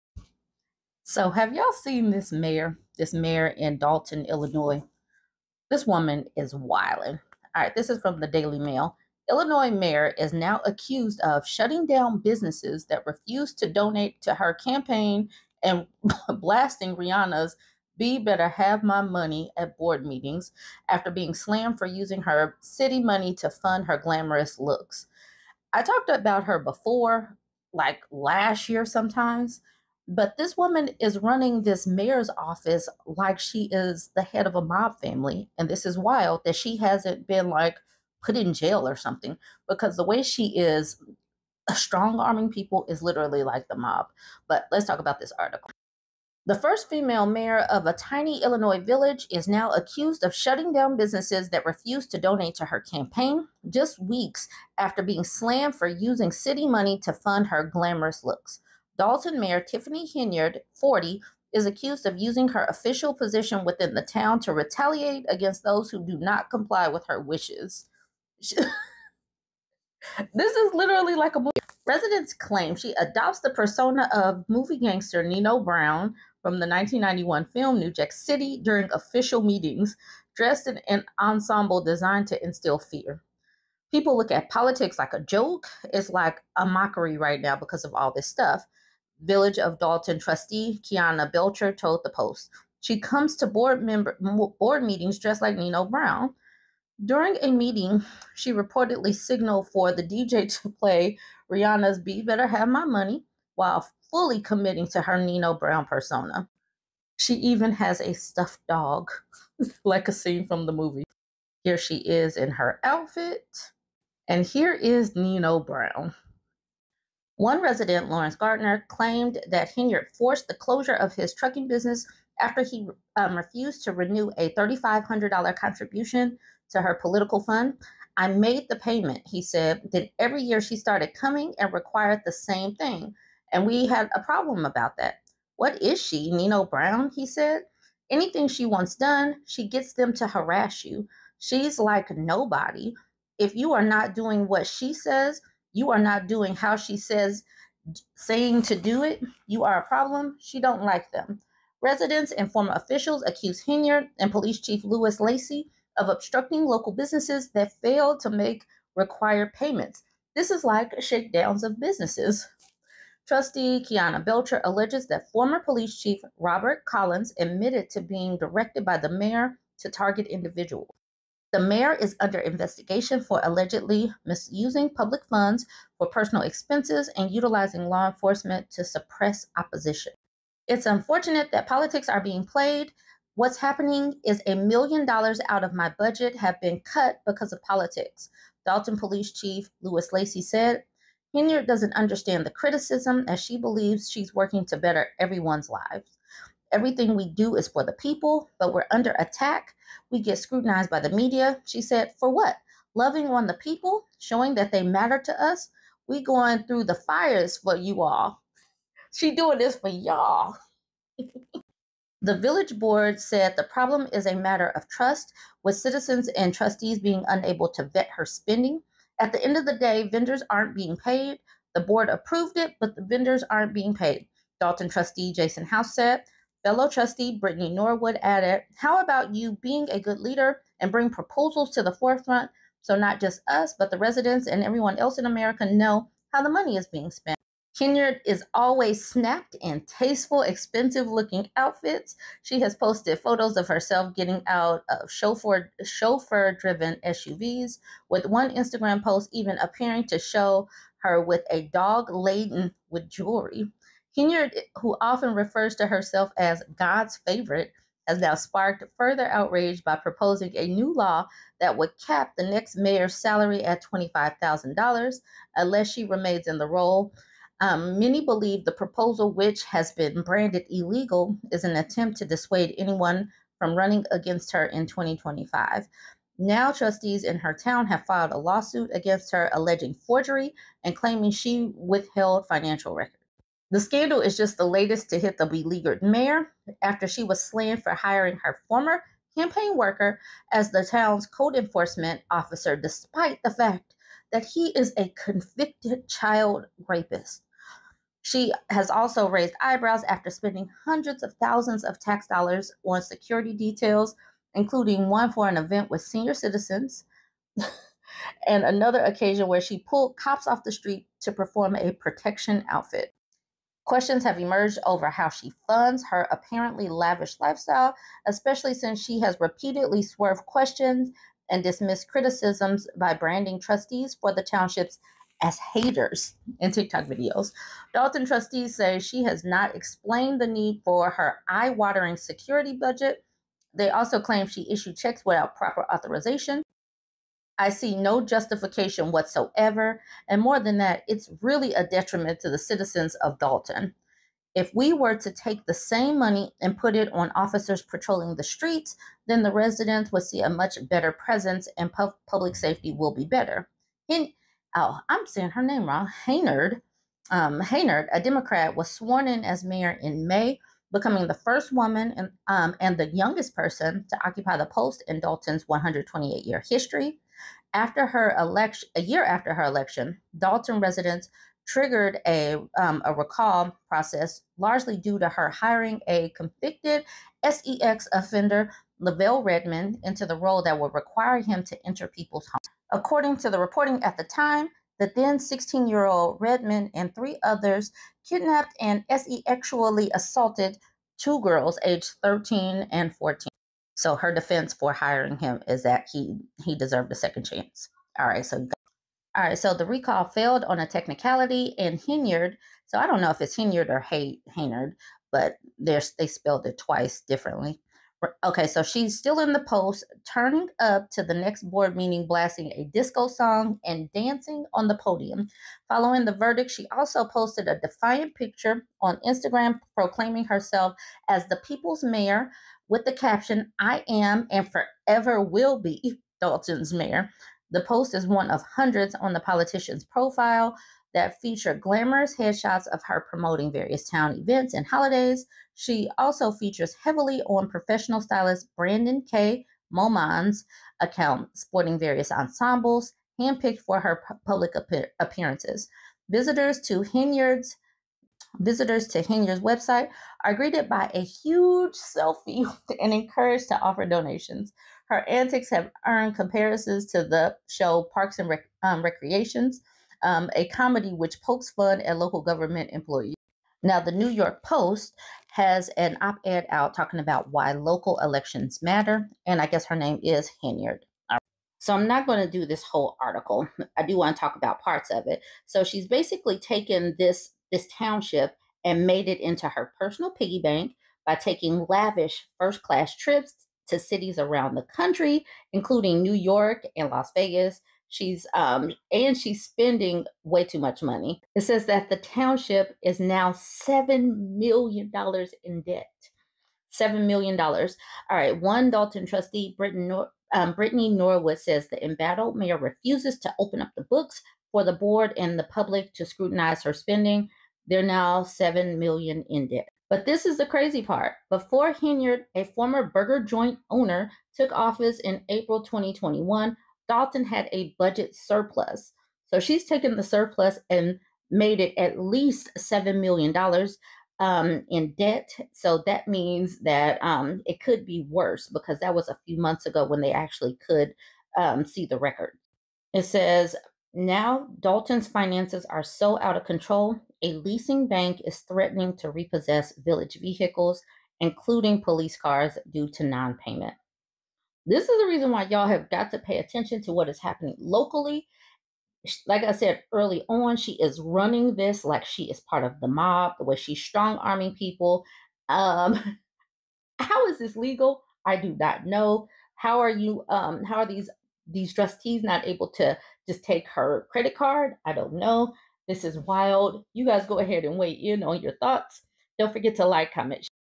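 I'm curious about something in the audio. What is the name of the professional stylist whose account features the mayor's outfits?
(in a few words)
Brandon K. Moman.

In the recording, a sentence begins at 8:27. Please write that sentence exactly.
They're now 7 million in debt.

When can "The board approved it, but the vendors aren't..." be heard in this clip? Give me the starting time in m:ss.
3:41.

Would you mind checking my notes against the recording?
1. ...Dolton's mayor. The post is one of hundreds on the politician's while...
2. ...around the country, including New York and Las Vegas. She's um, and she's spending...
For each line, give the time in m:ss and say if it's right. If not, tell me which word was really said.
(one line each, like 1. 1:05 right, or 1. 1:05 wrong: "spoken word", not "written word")
1. 7:06 wrong: "profile", not "while"
2. 8:04 right.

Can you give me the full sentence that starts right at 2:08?
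I made the payment, he said.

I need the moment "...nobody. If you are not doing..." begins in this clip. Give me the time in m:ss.
2:22.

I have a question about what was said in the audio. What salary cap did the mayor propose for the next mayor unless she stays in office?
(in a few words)
$25,000.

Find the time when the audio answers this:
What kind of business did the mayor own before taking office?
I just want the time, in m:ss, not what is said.
8:33.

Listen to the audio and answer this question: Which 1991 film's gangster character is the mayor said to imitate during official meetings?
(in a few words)
New Jack City.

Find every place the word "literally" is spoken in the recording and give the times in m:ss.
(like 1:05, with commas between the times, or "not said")
0:43, 1:10.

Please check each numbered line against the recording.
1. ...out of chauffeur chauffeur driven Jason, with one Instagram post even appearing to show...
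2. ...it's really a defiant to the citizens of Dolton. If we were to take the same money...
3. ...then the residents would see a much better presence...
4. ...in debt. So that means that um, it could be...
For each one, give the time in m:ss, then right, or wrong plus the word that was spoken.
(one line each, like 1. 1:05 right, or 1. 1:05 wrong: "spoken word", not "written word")
1. 4:04 wrong: "SUVs", not "Jason"
2. 5:41 wrong: "detriment", not "defiant"
3. 5:49 right
4. 8:44 right.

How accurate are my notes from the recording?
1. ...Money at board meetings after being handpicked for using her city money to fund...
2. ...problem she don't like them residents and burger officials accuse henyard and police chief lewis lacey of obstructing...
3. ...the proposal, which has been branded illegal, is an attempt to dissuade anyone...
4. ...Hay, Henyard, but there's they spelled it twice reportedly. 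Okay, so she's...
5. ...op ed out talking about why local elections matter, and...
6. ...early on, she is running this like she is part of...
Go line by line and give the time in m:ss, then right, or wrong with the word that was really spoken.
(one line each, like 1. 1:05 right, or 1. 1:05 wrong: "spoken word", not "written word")
1. 0:19 wrong: "slammed", not "handpicked"
2. 2:29 wrong: "former", not "burger"
3. 4:28 right
4. 6:43 wrong: "differently", not "reportedly"
5. 7:46 right
6. 9:10 right.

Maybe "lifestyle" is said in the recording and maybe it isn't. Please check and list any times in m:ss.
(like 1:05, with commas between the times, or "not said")
5:17.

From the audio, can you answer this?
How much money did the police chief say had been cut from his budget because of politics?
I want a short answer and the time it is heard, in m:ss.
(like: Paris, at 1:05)
a million dollars, at 3:04.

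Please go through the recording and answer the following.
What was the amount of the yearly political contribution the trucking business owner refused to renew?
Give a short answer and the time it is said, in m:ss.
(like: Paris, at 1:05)
$3,500, at 2:04.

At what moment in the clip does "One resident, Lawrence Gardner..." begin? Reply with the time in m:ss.
1:57.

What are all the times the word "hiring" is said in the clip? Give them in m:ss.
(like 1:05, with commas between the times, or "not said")
4:47, 6:15, 6:34.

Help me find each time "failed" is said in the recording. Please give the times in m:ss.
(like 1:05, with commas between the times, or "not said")
2:37, 6:40.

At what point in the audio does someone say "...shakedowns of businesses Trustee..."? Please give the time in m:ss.
2:41.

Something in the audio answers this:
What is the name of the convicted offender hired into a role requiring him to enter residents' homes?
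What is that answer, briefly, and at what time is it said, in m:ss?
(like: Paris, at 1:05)
Lavelle Redmond, at 6:18.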